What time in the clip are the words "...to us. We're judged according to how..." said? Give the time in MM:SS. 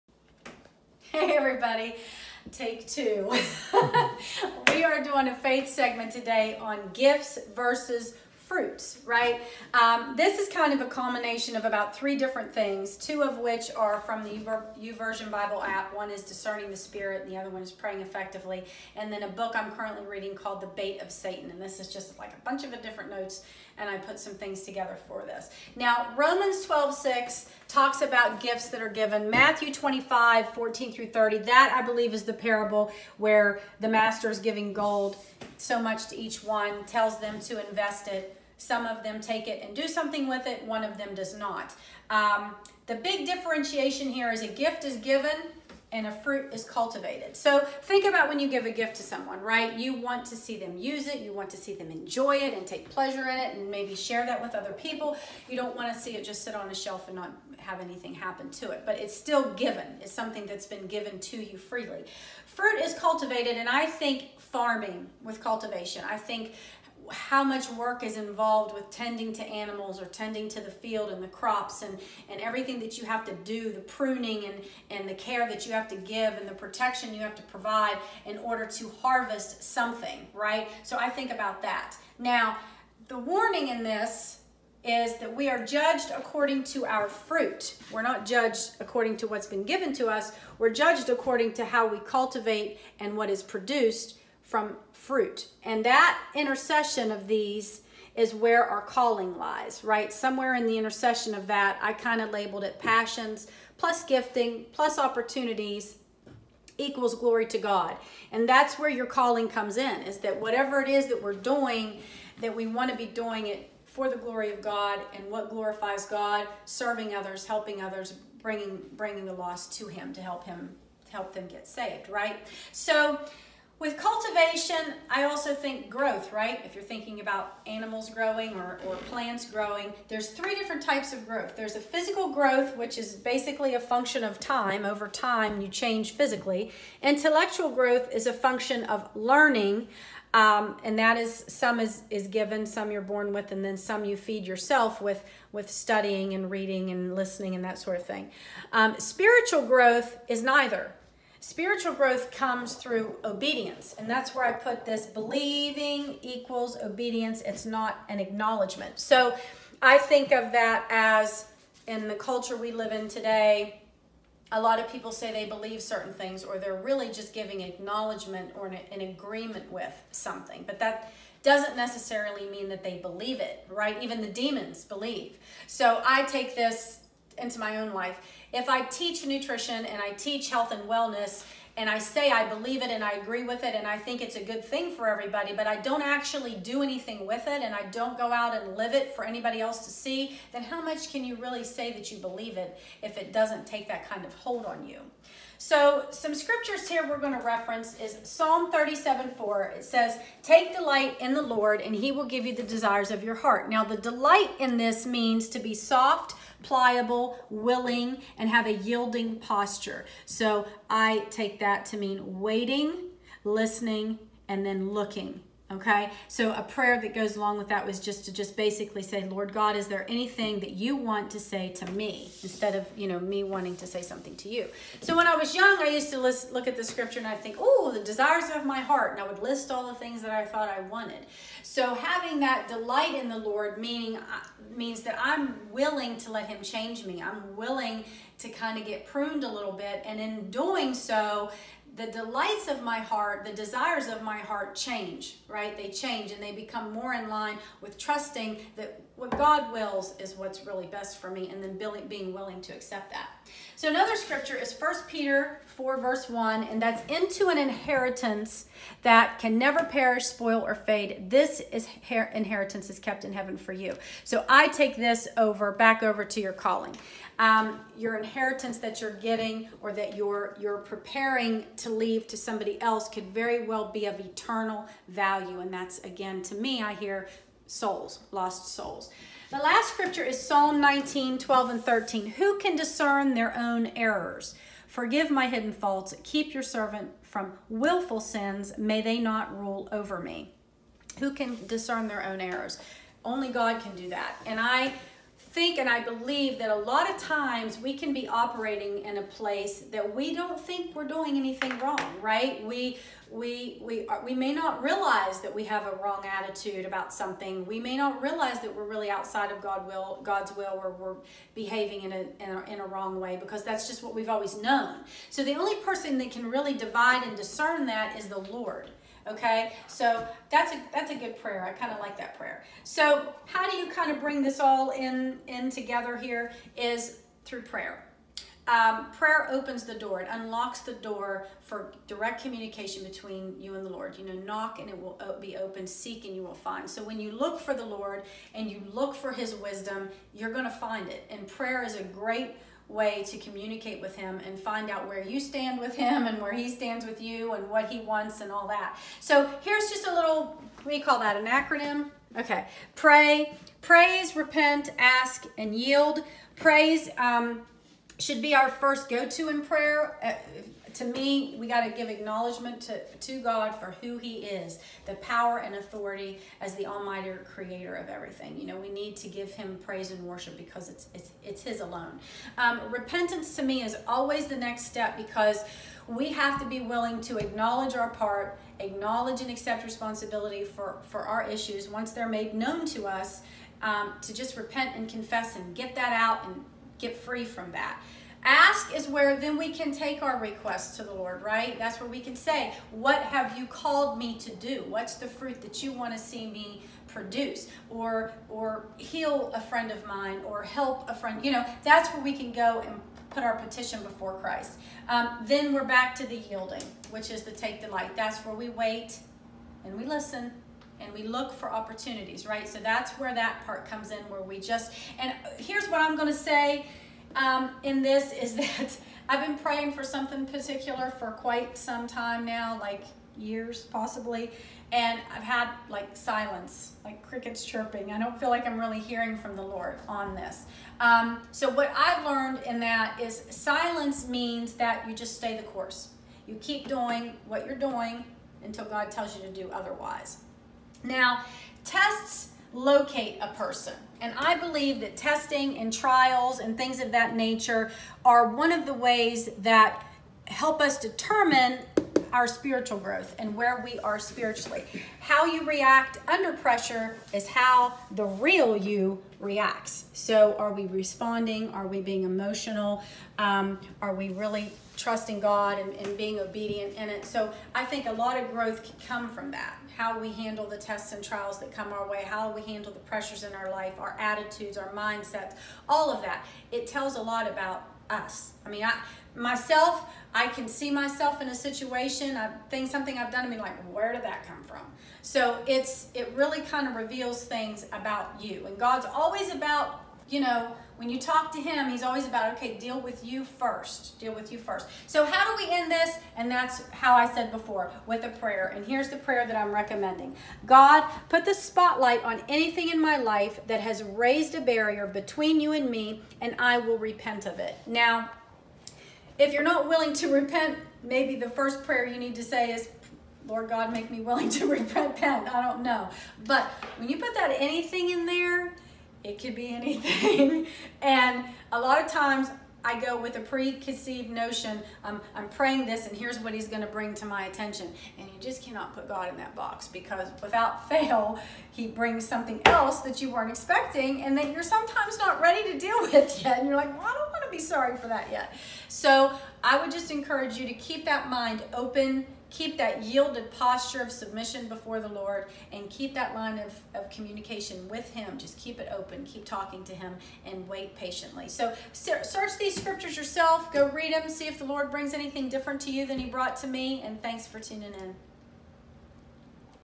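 01:29.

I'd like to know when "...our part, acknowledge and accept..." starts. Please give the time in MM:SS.
06:17.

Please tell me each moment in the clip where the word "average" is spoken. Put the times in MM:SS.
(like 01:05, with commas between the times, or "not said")
not said.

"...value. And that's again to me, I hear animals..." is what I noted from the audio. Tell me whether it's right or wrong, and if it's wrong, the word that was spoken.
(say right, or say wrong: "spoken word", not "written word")
wrong: "souls", not "animals".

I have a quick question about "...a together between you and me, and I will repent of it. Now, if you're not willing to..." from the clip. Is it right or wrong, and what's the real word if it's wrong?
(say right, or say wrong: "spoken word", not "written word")
wrong: "barrier", not "together".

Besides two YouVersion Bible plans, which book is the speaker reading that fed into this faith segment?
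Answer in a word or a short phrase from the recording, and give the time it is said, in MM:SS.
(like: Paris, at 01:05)
The Bait of Satan, at 00:20.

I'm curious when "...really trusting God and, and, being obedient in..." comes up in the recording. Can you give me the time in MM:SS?
07:44.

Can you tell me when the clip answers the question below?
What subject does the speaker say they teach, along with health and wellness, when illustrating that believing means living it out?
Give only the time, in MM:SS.
02:59.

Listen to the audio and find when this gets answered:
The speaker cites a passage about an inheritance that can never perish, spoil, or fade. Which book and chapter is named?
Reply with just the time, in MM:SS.
04:14.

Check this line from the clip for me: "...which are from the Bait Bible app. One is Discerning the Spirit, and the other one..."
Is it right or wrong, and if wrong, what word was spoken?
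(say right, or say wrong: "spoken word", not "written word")
wrong: "YouVersion", not "Bait".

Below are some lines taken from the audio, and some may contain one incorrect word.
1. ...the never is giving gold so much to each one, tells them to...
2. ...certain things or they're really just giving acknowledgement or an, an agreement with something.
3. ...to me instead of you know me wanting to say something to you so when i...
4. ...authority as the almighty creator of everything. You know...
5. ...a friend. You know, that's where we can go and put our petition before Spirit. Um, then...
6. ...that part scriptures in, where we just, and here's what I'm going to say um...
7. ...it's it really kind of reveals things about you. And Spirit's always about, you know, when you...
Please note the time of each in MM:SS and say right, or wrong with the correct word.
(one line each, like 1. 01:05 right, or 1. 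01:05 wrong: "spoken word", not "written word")
1. 00:33 wrong: "master", not "never"
2. 02:45 right
3. 03:41 right
4. 06:05 right
5. 06:41 wrong: "Christ", not "Spirit"
6. 06:53 wrong: "comes", not "scriptures"
7. 08:05 wrong: "God", not "Spirit".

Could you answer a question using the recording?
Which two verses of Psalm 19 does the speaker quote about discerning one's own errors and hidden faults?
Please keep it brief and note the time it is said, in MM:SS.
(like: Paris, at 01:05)
12 and 13, at 04:41.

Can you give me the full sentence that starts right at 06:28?
Ask is where then we can take our request to the Lord, right?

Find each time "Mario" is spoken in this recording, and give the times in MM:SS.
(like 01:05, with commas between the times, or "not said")
not said.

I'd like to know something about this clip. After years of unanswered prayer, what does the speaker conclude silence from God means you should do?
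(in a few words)
Stay the course.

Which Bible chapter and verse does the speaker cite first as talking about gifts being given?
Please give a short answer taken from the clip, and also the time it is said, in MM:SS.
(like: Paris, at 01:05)
Romans 12:6, at 00:26.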